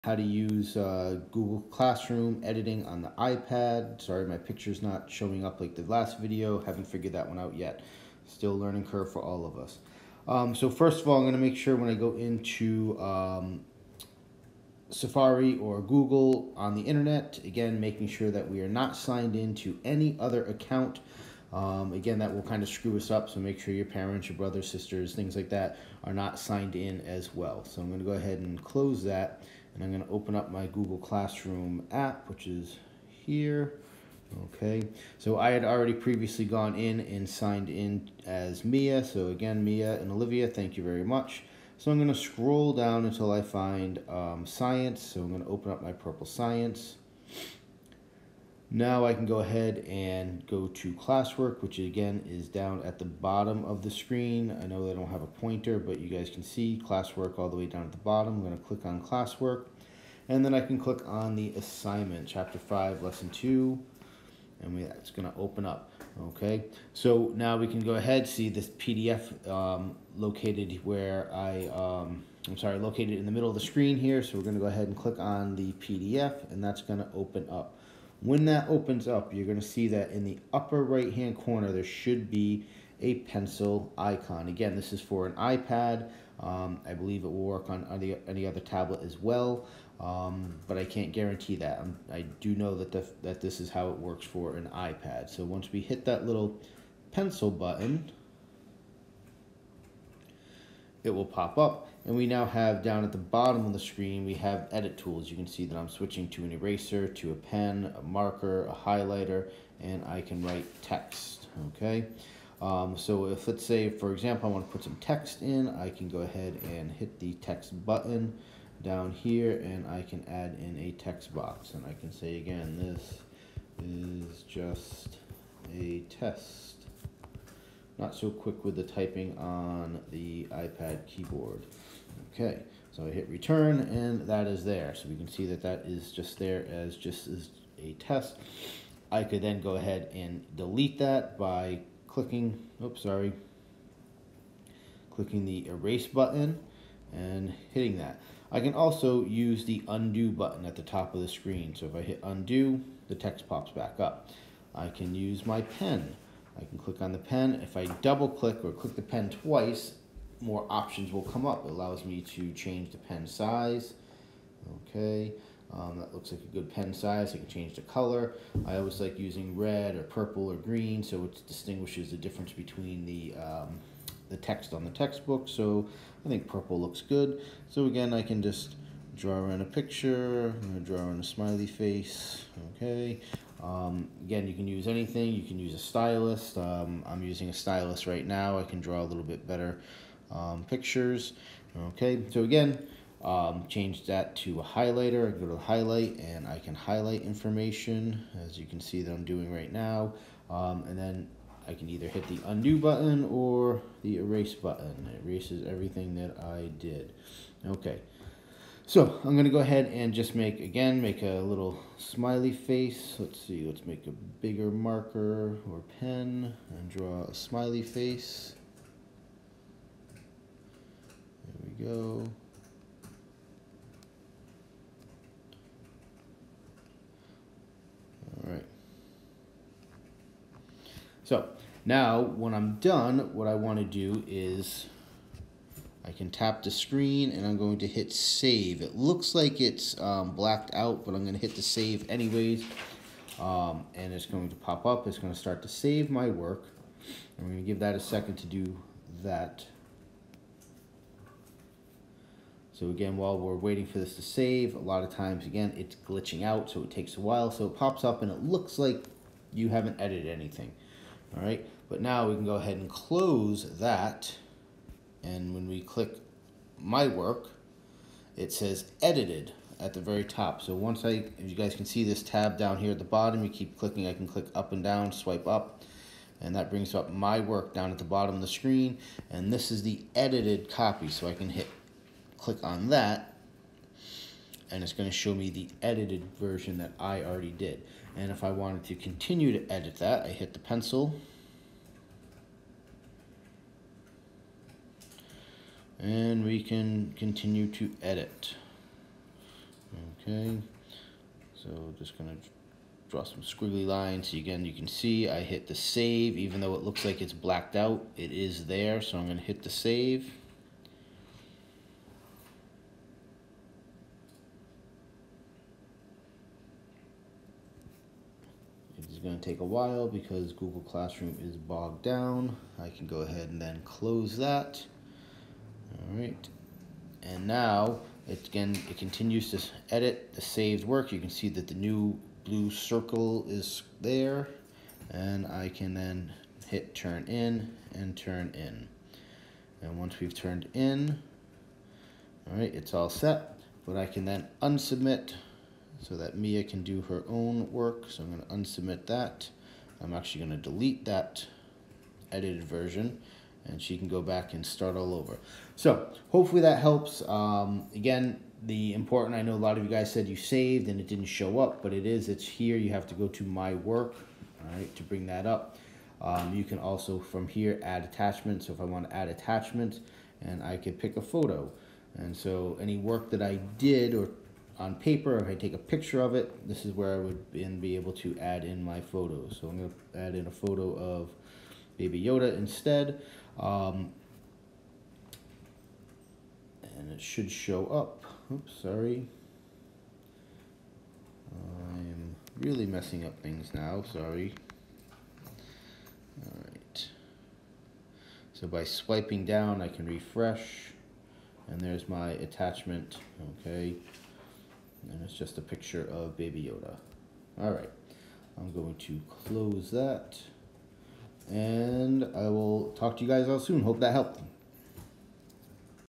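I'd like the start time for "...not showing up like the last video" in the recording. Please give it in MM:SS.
00:04.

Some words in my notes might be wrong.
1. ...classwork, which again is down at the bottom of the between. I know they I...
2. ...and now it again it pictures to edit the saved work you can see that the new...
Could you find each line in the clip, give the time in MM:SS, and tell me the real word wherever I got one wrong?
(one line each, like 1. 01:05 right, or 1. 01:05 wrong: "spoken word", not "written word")
1. 00:50 wrong: "screen", not "between"
2. 05:27 wrong: "continues", not "pictures".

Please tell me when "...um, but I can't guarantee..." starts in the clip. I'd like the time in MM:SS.
01:29.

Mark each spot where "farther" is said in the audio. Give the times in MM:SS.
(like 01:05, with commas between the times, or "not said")
not said.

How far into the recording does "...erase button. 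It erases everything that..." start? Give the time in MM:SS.
03:24.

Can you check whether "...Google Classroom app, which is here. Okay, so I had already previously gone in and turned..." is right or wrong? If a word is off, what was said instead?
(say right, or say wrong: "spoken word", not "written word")
wrong: "signed", not "turned".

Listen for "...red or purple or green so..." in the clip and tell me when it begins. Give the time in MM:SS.
02:49.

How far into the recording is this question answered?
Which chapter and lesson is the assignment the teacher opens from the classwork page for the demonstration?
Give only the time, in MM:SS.
01:02.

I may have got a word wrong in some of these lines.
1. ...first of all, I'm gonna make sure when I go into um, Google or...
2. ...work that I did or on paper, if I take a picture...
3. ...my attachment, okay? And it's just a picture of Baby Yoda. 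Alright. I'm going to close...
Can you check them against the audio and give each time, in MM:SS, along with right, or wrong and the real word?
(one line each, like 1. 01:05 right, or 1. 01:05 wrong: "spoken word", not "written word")
1. 00:10 wrong: "Safari", not "Google"
2. 06:12 right
3. 06:42 right.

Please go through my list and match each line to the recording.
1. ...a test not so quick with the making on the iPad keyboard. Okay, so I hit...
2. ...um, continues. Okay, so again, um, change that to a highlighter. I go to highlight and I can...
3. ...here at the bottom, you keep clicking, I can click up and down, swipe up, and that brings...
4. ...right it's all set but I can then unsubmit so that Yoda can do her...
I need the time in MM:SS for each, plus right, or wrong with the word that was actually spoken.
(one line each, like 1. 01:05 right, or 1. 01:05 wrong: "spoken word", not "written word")
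1. 02:05 wrong: "typing", not "making"
2. 03:10 wrong: "pictures", not "continues"
3. 04:32 right
4. 05:42 wrong: "Mia", not "Yoda".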